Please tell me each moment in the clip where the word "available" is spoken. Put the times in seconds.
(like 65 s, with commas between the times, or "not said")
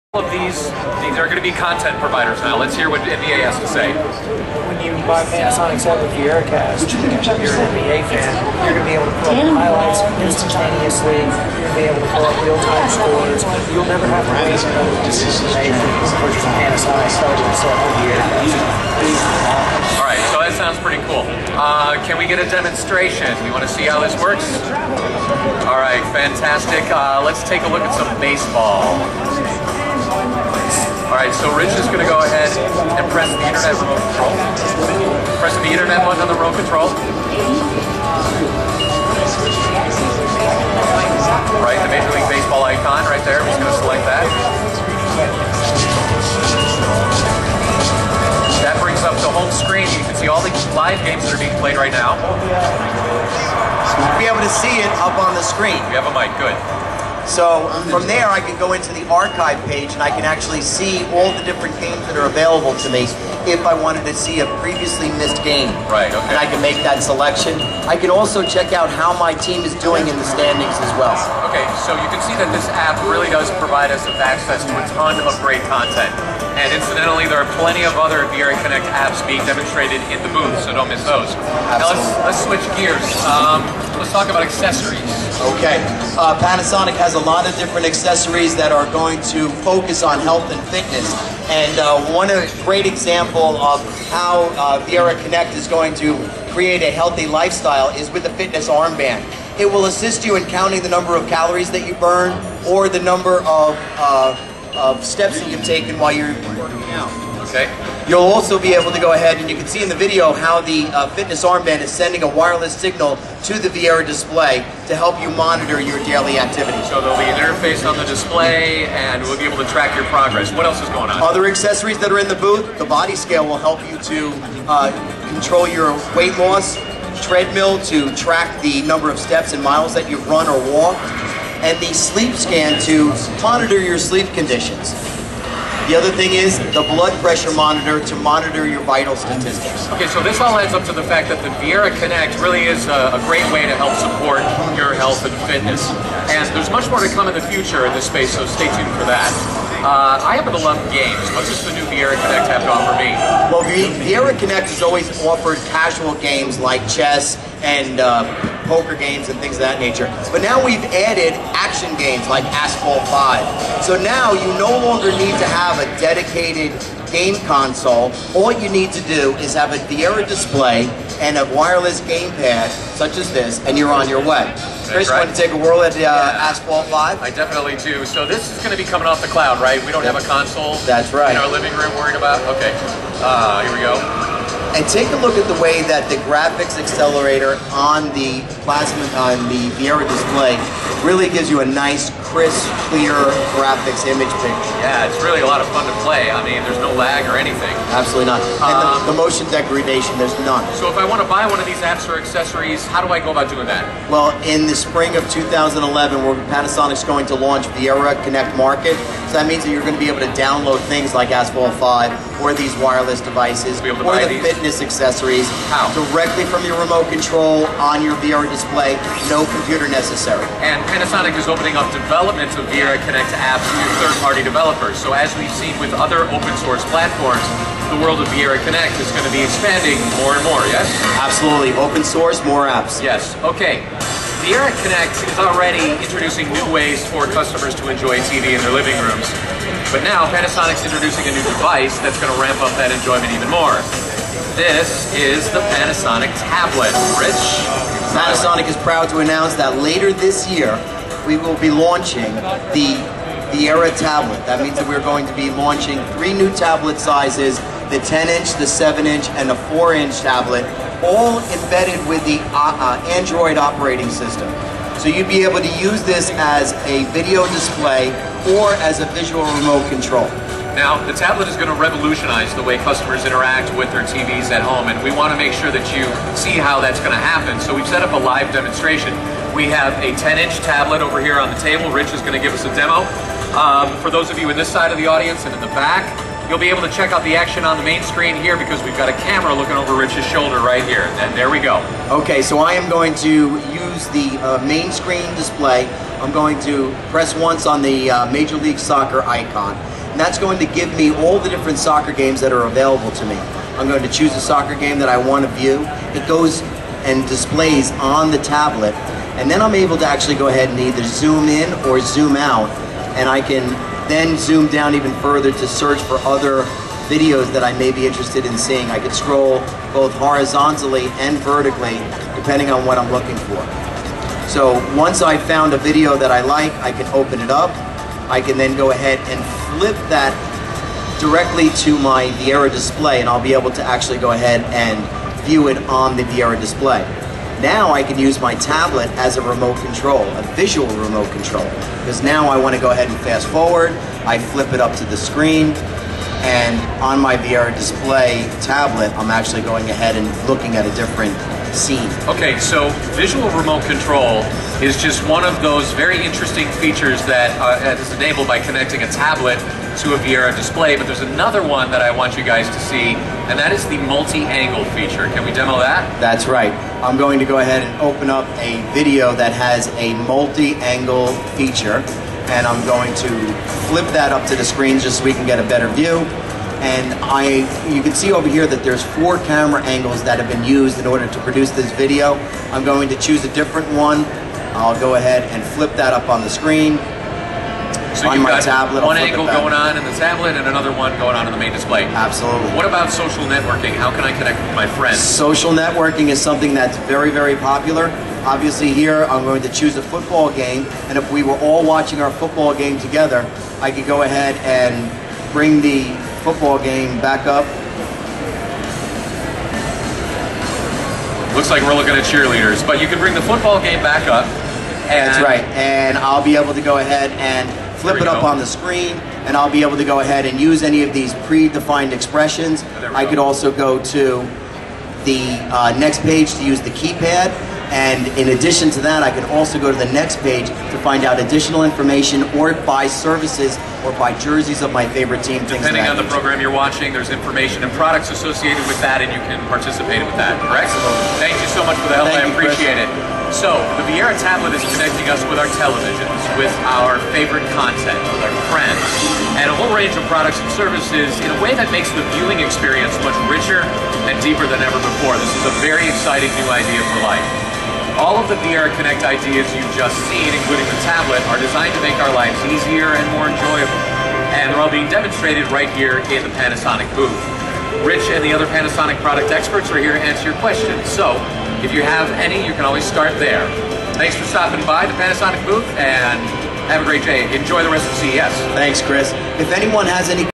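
62 s, 302 s.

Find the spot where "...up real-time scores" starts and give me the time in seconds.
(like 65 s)
12 s.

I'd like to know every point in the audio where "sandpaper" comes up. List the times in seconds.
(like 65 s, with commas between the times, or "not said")
not said.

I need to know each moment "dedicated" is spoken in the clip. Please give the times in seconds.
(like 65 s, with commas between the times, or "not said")
165 s.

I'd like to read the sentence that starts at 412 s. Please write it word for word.
But you can bring the football game back up.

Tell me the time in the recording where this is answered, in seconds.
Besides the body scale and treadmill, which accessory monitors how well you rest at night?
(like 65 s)
131 s.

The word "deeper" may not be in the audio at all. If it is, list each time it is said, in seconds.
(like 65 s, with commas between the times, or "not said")
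454 s.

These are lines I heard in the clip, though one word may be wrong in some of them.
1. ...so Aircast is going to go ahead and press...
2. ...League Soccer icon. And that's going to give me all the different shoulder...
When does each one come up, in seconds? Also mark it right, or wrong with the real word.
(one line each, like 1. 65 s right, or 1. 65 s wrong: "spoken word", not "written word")
1. 31 s wrong: "Rich", not "Aircast"
2. 298 s wrong: "soccer", not "shoulder".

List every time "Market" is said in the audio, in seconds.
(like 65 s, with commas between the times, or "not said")
208 s.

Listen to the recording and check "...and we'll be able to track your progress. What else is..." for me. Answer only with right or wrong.
right.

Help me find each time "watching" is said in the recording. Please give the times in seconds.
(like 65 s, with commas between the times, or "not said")
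401 s, 436 s.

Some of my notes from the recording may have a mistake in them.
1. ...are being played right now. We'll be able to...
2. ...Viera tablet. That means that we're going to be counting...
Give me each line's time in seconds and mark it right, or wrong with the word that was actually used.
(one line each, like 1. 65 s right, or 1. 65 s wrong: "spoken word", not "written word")
1. 51 s right
2. 253 s wrong: "launching", not "counting".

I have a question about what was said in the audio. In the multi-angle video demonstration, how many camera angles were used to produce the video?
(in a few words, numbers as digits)
4.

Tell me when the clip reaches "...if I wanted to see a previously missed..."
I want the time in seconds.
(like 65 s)
63 s.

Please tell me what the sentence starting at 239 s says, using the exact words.
But now Panasonic's introducing a new device that's going to ramp up that enjoyment even more.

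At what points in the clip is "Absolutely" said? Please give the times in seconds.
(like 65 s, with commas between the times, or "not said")
81 s, 197 s, 231 s, 392 s.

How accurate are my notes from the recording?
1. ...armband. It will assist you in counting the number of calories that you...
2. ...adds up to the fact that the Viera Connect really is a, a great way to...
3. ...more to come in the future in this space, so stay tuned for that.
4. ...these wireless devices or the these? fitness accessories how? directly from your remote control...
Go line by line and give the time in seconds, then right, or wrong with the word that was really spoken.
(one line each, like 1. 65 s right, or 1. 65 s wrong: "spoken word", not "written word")
1. 98 s right
2. 140 s right
3. 146 s right
4. 212 s right.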